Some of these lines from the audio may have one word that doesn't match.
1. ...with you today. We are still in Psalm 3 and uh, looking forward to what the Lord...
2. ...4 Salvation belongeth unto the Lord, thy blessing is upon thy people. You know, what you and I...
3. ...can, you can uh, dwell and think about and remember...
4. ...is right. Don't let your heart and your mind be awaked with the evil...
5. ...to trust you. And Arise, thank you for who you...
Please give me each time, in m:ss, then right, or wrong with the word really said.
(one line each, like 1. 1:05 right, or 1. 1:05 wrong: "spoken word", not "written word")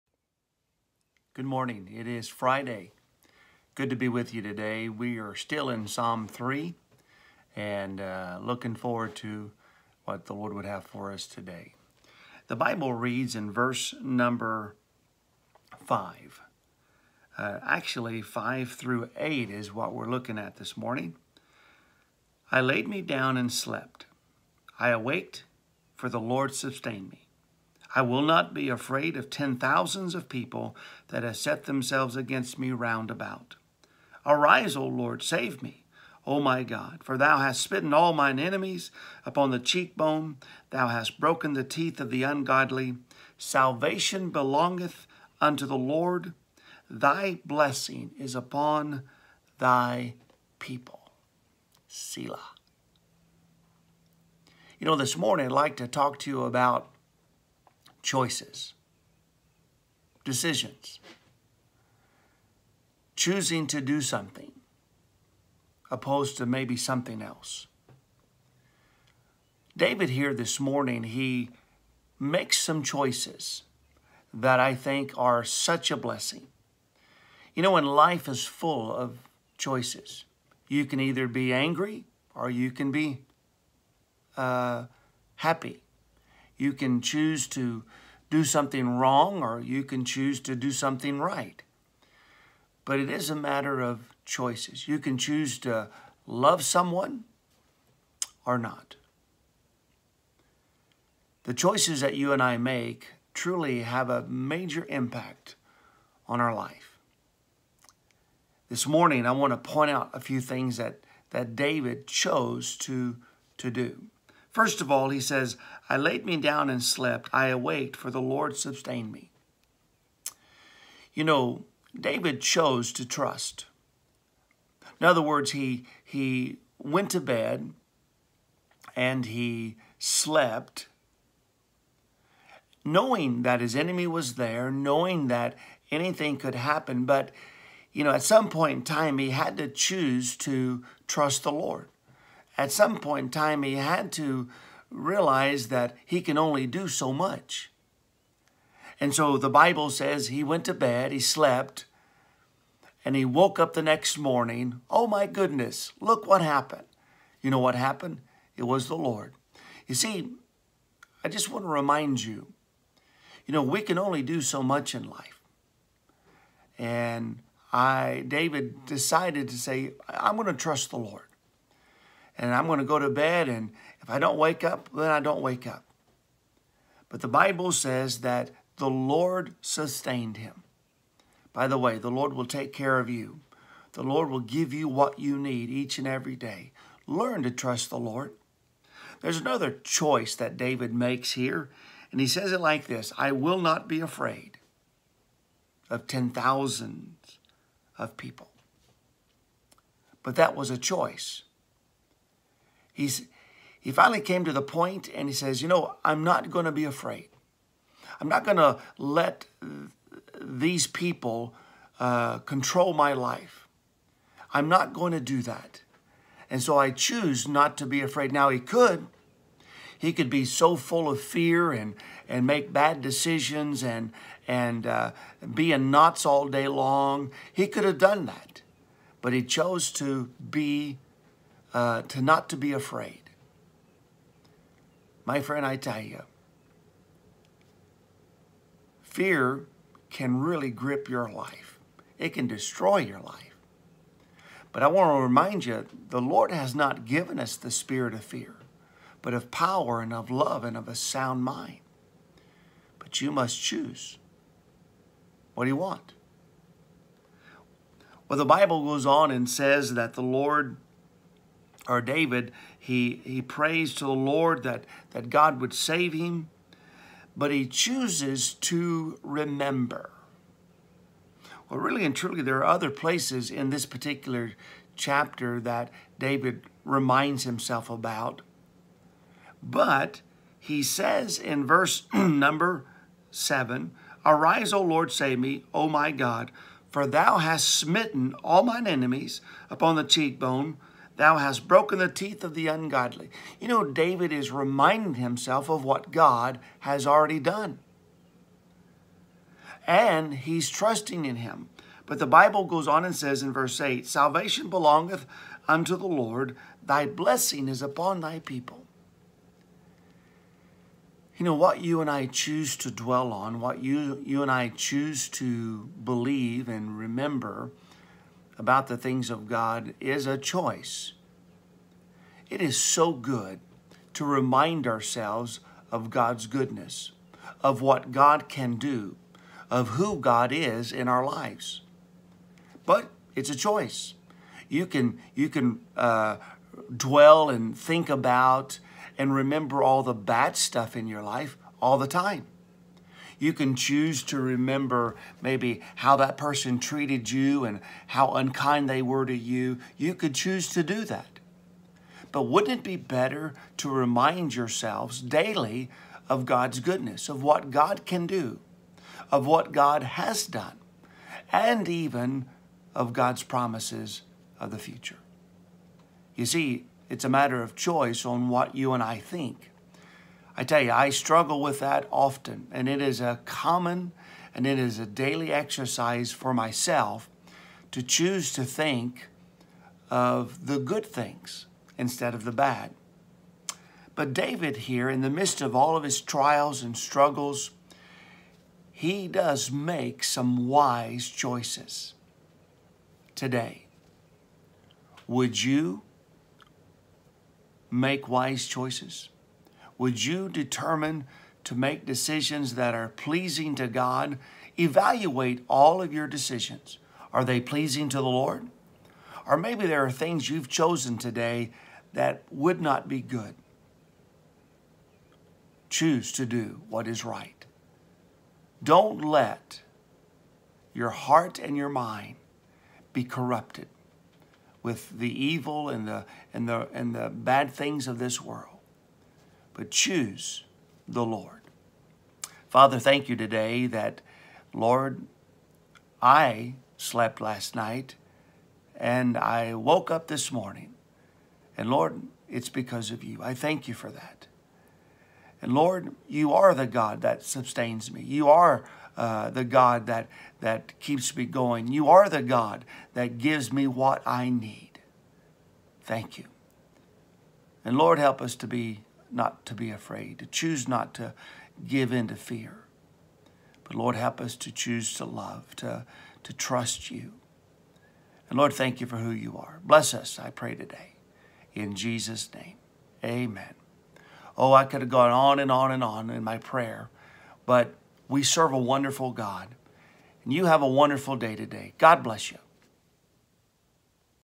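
1. 0:04 right
2. 5:03 wrong: "8", not "4"
3. 5:34 right
4. 6:57 wrong: "corrupted", not "awaked"
5. 7:46 wrong: "Lord", not "Arise".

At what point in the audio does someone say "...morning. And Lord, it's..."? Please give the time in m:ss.
7:20.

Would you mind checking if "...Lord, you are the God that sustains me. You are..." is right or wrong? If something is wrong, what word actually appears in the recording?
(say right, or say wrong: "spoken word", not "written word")
right.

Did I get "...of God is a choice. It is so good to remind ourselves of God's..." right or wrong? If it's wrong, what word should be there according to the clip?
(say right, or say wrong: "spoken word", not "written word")
right.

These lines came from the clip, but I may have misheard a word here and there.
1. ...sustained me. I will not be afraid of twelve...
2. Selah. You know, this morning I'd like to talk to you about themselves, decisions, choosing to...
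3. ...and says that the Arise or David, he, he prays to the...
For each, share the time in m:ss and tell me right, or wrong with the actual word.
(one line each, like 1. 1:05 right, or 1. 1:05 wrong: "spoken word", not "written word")
1. 0:26 wrong: "ten", not "twelve"
2. 0:51 wrong: "choices", not "themselves"
3. 4:19 wrong: "Lord", not "Arise".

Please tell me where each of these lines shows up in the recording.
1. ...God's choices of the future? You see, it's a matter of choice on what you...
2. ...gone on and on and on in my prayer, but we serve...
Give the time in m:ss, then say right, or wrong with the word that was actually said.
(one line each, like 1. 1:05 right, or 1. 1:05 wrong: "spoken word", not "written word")
1. 6:03 wrong: "promises", not "choices"
2. 7:55 right.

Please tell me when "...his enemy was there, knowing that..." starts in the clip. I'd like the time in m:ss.
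2:13.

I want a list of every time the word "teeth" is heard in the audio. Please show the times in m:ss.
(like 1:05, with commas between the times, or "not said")
0:41, 4:52.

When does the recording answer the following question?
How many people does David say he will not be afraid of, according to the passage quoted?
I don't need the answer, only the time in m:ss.
3:16.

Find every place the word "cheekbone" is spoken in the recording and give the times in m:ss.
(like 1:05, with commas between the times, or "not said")
0:39, 4:50.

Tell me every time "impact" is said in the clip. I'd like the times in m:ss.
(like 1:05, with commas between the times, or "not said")
1:44.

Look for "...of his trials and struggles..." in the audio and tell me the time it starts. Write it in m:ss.
6:25.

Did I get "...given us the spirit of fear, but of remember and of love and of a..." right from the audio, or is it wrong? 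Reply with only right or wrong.
wrong.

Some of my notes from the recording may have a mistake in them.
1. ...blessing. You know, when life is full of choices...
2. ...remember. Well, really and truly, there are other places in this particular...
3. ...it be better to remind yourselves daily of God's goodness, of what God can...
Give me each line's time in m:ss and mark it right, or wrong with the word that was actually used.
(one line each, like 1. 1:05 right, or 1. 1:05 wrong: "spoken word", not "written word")
1. 1:15 right
2. 4:29 right
3. 5:52 right.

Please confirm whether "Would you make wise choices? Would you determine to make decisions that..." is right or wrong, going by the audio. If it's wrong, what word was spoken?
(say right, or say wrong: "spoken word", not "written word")
right.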